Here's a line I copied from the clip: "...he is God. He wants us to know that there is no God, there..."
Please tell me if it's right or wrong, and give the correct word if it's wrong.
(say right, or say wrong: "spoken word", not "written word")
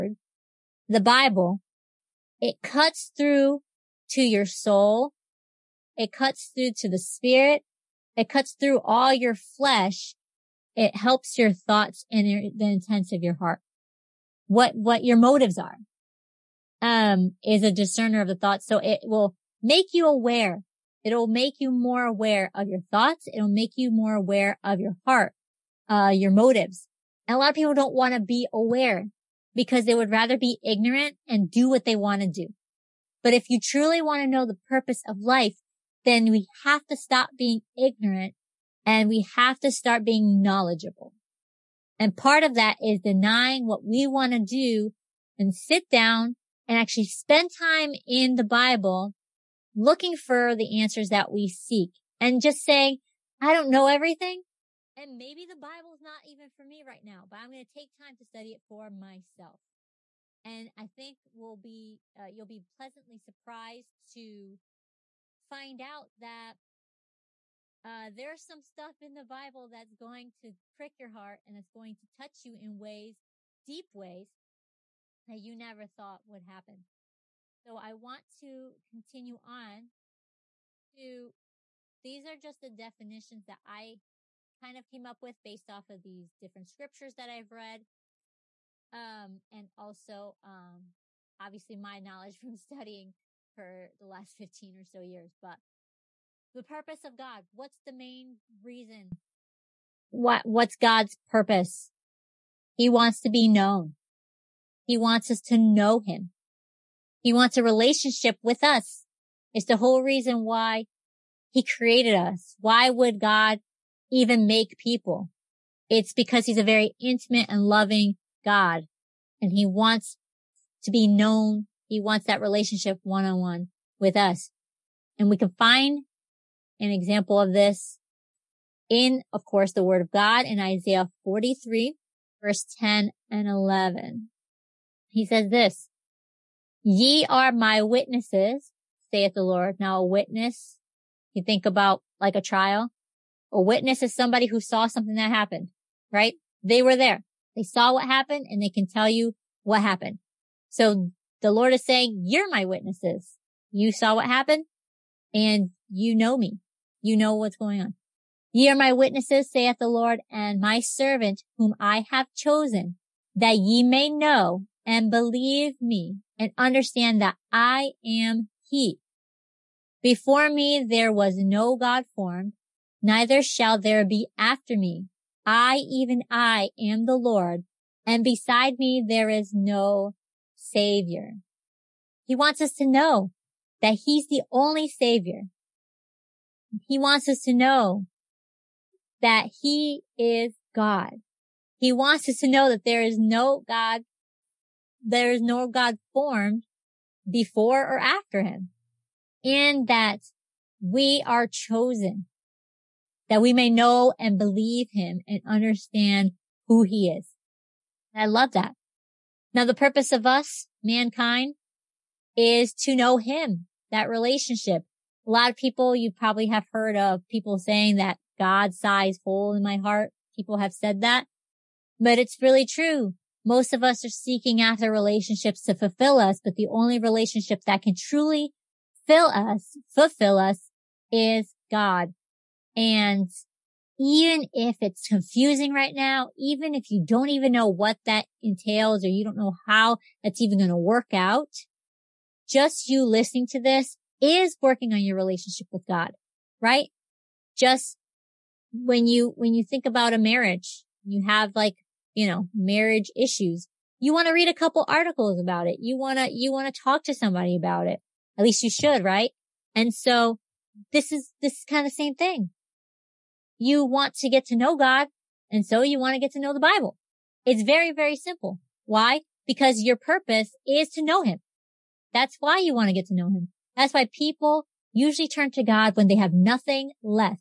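right.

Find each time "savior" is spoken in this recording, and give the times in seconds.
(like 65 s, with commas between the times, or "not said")
180 s, 184 s.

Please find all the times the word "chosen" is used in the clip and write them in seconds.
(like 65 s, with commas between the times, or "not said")
162 s, 201 s.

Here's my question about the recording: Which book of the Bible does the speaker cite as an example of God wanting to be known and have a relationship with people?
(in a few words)
Isaiah.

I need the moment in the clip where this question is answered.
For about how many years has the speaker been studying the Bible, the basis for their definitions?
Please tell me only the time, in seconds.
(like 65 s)
94 s.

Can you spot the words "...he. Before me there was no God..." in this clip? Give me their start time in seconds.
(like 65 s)
168 s.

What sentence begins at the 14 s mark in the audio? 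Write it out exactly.
What, what your motives are, um, is a discerner of the thoughts.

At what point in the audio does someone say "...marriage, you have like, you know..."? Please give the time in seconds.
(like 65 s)
250 s.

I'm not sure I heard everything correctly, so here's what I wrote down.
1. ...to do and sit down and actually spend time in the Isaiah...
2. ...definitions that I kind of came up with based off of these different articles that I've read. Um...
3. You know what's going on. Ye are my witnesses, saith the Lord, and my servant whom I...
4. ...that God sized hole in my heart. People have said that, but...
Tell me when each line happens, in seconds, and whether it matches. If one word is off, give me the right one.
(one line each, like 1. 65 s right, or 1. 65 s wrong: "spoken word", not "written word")
1. 44 s wrong: "Bible", not "Isaiah"
2. 82 s wrong: "scriptures", not "articles"
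3. 157 s right
4. 217 s right.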